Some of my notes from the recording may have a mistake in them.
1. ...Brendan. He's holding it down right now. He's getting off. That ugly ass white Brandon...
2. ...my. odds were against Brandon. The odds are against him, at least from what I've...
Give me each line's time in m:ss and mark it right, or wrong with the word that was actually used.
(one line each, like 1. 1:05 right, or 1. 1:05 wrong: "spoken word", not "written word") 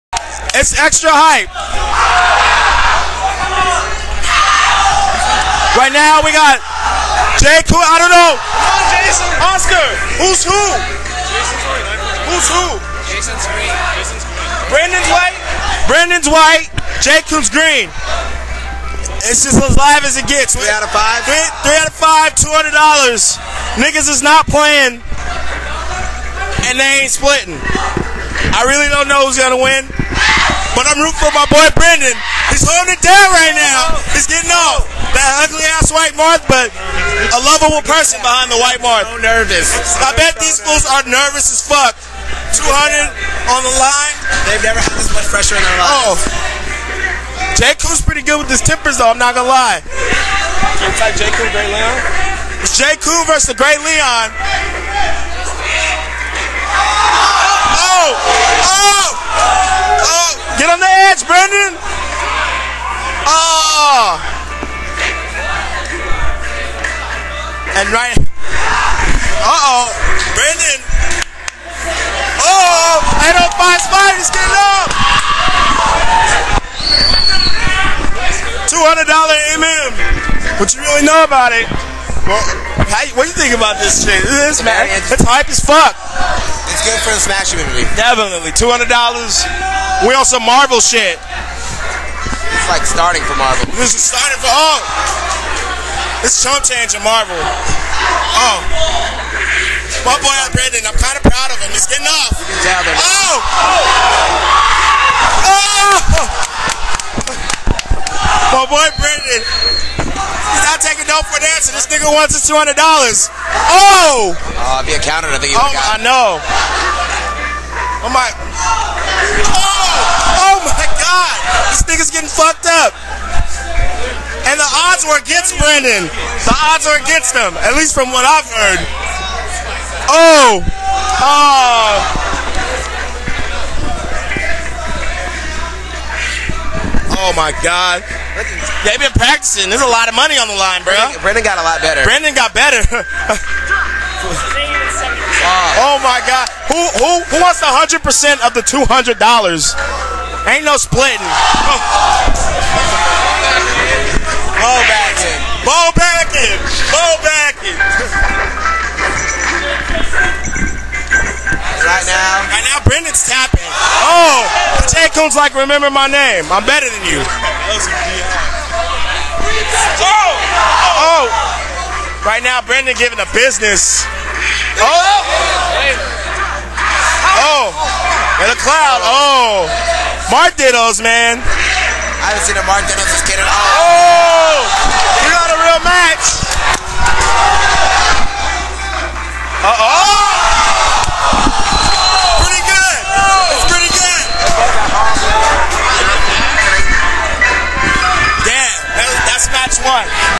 1. 0:31 wrong: "Marth", not "Brandon"
2. 1:58 right.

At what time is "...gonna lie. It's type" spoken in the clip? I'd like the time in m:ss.
0:49.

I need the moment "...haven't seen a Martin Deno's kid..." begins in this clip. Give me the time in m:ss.
3:02.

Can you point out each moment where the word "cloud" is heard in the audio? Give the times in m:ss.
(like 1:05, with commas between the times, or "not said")
2:58.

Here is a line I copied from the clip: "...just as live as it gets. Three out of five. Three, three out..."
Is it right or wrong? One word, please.
right.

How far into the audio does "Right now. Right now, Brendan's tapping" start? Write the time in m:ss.
2:41.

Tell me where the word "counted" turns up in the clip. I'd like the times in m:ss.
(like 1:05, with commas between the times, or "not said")
1:55.